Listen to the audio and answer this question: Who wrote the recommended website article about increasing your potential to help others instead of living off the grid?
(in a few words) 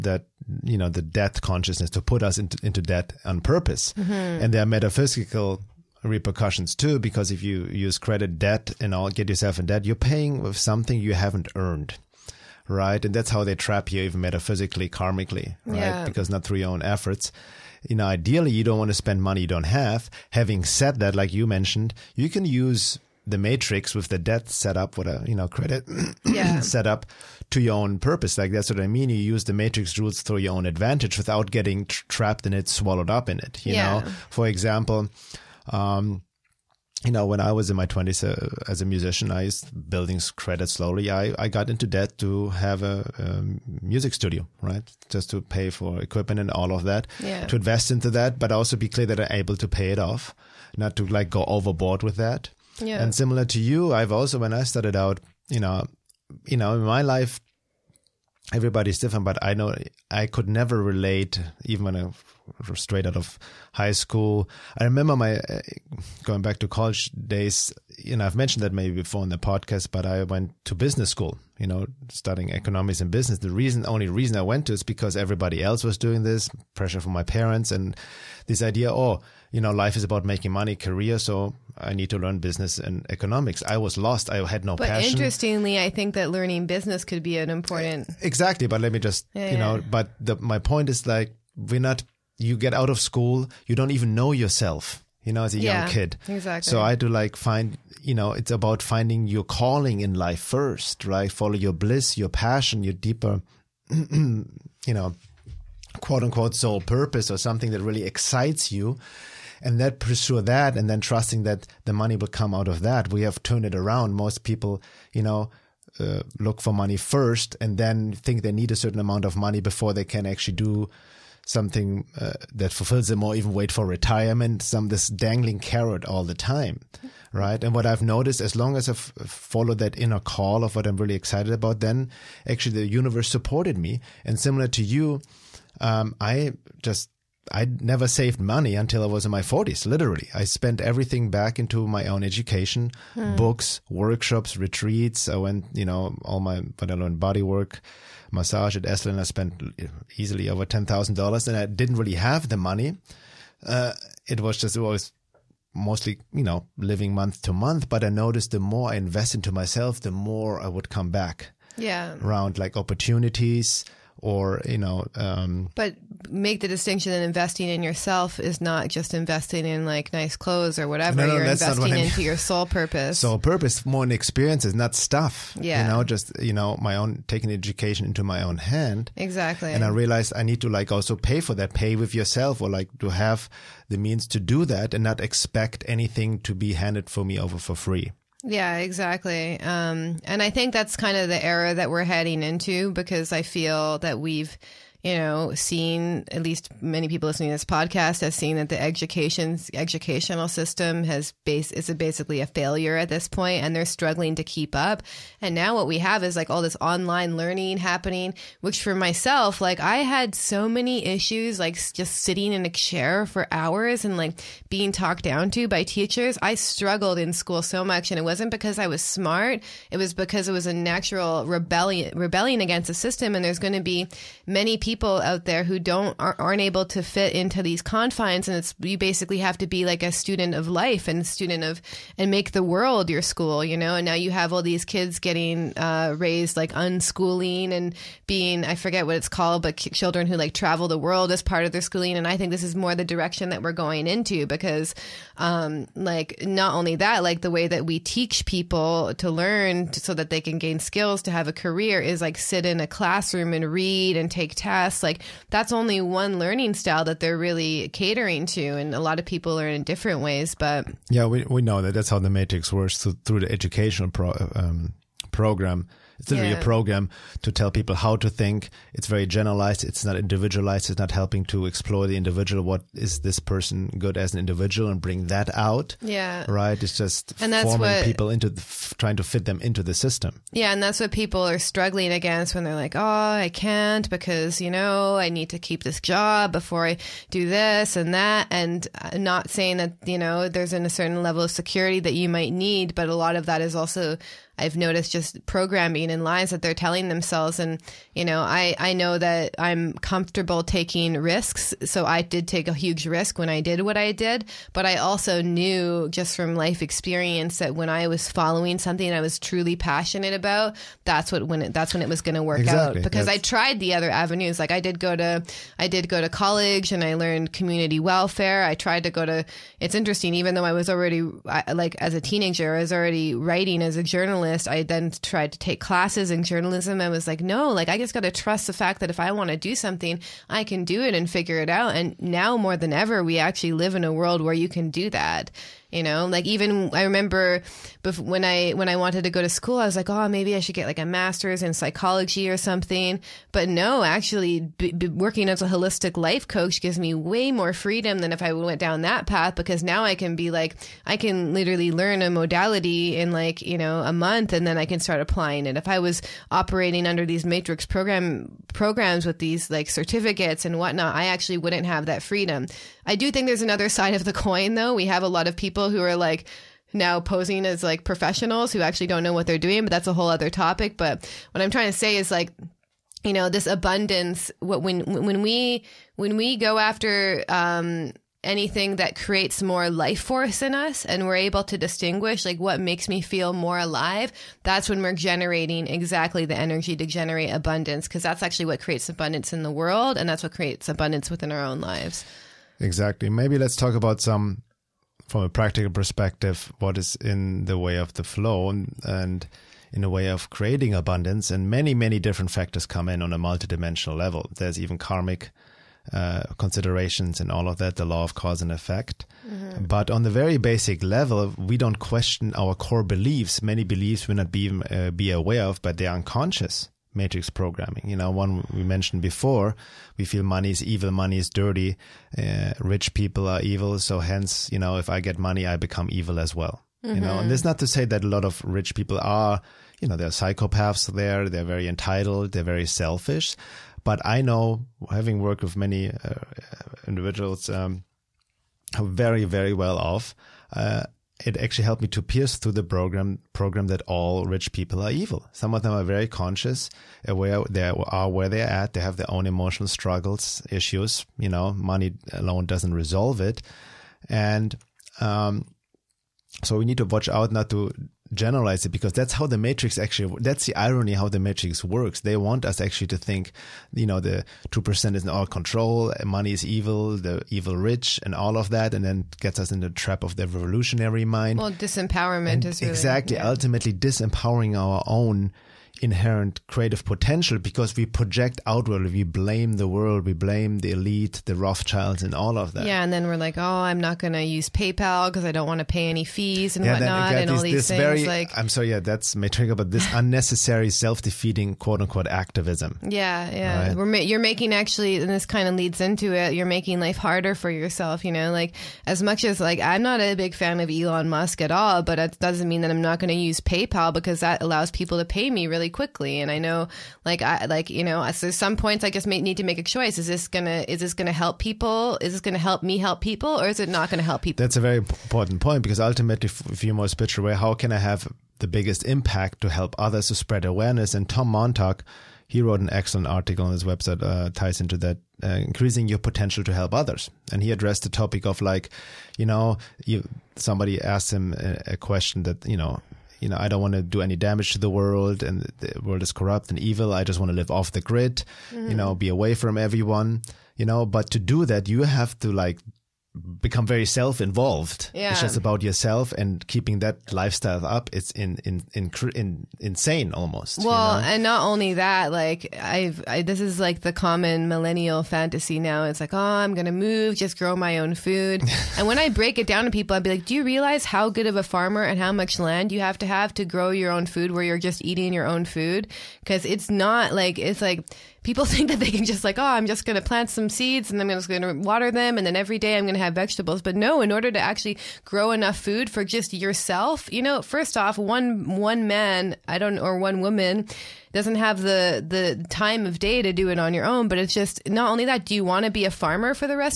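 Tom Montalk.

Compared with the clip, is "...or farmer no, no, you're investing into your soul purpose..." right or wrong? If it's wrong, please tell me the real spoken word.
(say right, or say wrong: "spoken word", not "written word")
wrong: "whatever", not "farmer".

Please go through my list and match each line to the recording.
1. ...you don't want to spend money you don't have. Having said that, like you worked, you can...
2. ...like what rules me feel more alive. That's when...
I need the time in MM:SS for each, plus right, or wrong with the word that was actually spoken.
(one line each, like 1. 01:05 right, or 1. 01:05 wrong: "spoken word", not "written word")
1. 00:18 wrong: "mentioned", not "worked"
2. 06:22 wrong: "makes", not "rules".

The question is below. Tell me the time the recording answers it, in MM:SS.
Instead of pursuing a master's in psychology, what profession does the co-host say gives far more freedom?
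05:45.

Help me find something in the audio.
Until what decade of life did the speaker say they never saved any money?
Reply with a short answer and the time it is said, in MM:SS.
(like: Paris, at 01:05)
40s, at 02:19.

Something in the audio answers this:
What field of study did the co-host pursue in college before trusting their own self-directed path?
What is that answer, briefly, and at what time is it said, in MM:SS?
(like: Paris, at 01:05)
Community welfare, at 05:17.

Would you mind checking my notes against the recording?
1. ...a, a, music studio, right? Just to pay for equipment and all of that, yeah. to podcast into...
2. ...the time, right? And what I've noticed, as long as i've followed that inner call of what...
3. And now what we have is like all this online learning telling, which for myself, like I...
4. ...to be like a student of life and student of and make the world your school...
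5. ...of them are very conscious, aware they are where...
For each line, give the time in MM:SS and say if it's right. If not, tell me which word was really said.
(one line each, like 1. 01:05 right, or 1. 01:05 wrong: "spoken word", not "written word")
1. 00:42 wrong: "invest", not "podcast"
2. 02:06 right
3. 03:25 wrong: "happening", not "telling"
4. 03:49 right
5. 07:25 right.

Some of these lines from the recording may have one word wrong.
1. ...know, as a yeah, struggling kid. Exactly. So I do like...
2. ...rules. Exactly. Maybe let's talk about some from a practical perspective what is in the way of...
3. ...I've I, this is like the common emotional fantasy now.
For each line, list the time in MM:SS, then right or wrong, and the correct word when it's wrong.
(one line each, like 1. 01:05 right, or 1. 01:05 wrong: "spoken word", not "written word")
1. 01:35 wrong: "young", not "struggling"
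2. 06:31 wrong: "lives", not "rules"
3. 09:12 wrong: "millennial", not "emotional".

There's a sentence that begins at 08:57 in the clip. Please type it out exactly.
I just want to live off the grid, mm-hmm.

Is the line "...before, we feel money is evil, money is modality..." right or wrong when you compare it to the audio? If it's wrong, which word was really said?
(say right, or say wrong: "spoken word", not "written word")
wrong: "dirty", not "modality".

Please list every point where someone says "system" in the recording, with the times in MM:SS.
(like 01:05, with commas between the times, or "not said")
03:20, 03:42, 04:39.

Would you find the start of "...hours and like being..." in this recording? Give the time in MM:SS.
03:33.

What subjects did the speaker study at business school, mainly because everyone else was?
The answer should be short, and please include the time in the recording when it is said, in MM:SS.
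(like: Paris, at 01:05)
Economics and business, at 01:12.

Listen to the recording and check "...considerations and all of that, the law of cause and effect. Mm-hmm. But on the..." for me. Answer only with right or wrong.
right.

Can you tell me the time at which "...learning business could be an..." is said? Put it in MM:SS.
01:26.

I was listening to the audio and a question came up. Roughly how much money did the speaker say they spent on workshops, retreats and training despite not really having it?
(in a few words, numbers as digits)
Over $10,000.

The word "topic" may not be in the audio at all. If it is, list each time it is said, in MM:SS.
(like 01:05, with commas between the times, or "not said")
06:10, 08:48.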